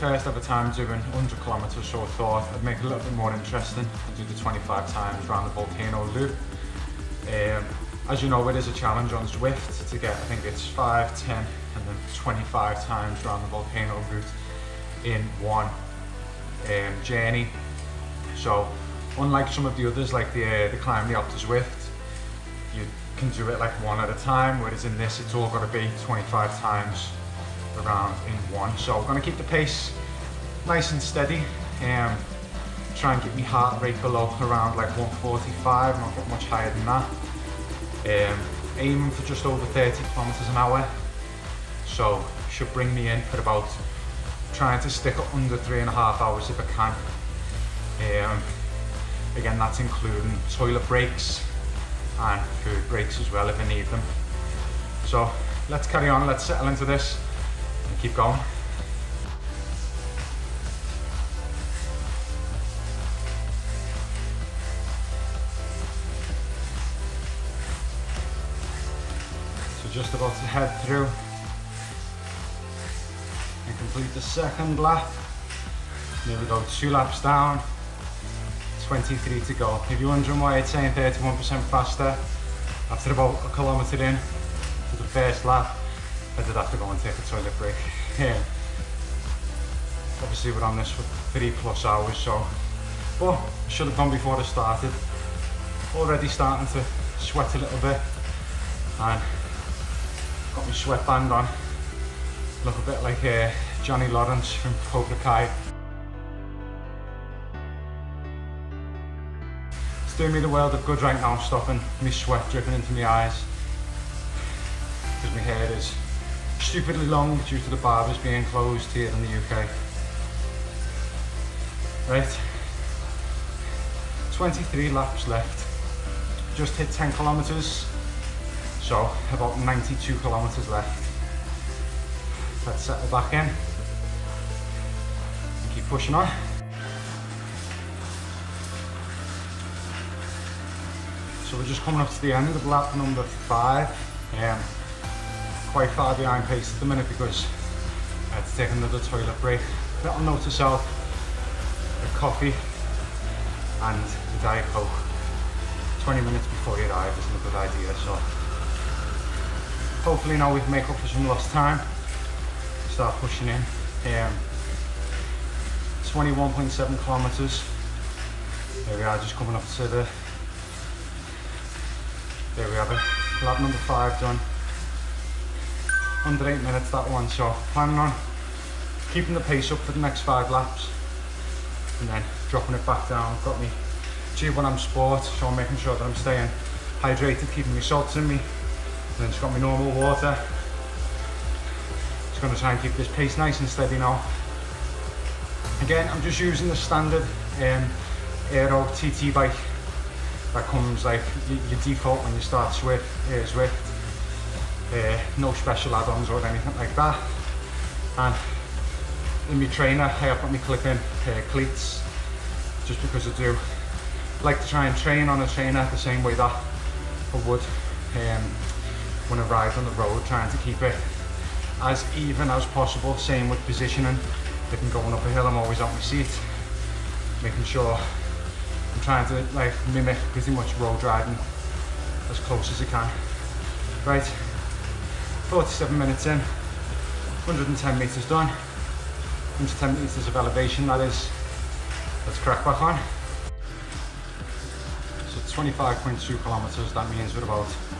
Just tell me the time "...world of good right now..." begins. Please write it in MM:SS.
01:50.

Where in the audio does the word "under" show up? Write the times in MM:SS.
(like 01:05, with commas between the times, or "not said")
00:45, 02:56.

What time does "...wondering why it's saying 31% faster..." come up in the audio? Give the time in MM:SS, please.
01:20.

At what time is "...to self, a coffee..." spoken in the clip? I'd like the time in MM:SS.
02:30.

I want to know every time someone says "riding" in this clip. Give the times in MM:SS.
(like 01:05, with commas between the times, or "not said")
03:51.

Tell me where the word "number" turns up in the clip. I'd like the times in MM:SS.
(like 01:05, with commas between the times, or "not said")
02:22, 02:53.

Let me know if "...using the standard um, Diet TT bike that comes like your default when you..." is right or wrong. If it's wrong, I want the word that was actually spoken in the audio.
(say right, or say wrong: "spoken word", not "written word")
wrong: "Aero", not "Diet".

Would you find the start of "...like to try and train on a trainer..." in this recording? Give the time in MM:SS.
03:34.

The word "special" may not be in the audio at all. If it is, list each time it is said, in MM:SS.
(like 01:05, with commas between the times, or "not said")
03:25.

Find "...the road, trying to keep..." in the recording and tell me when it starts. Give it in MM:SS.
03:39.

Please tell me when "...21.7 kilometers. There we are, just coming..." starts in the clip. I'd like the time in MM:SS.
02:46.